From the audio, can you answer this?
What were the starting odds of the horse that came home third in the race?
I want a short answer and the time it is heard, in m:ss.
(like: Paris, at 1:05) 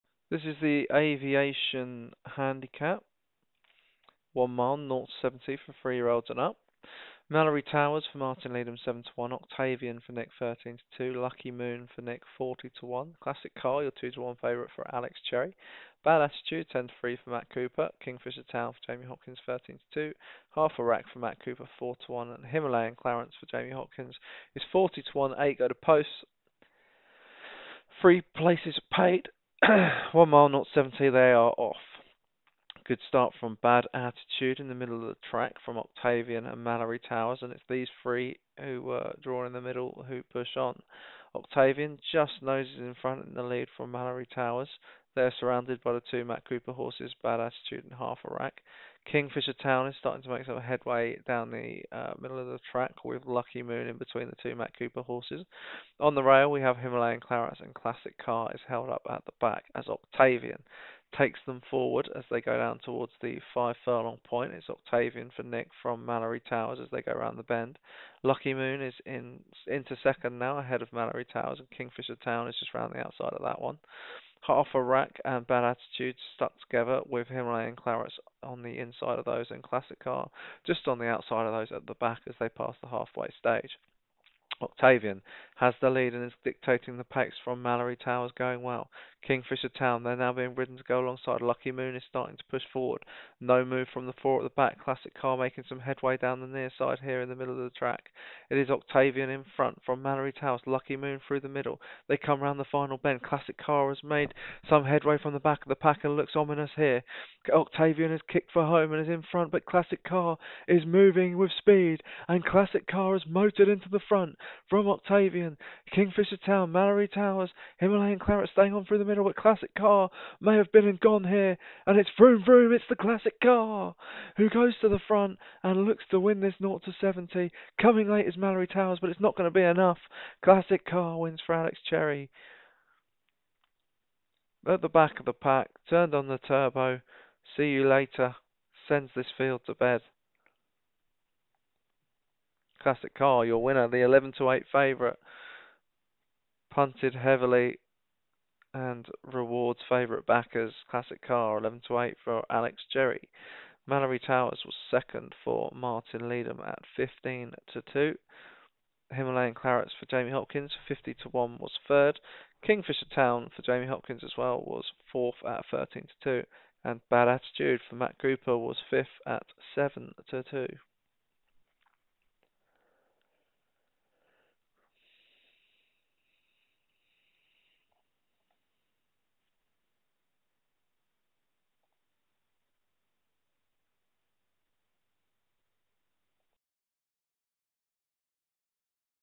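50 to 1, at 2:40.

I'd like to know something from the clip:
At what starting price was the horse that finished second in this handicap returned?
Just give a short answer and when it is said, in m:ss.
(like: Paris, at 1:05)
15 to 2, at 2:36.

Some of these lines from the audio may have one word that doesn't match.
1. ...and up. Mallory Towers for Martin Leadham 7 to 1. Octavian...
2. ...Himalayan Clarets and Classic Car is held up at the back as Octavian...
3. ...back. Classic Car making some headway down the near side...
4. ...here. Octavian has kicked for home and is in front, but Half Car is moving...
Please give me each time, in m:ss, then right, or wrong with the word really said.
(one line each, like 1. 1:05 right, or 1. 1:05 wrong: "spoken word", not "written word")
1. 0:06 right
2. 0:56 right
3. 1:34 right
4. 1:46 wrong: "Classic", not "Half".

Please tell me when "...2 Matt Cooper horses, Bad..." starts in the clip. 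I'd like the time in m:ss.
0:46.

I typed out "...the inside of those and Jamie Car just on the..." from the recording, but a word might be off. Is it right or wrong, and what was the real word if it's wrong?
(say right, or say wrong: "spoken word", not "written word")
wrong: "Classic", not "Jamie".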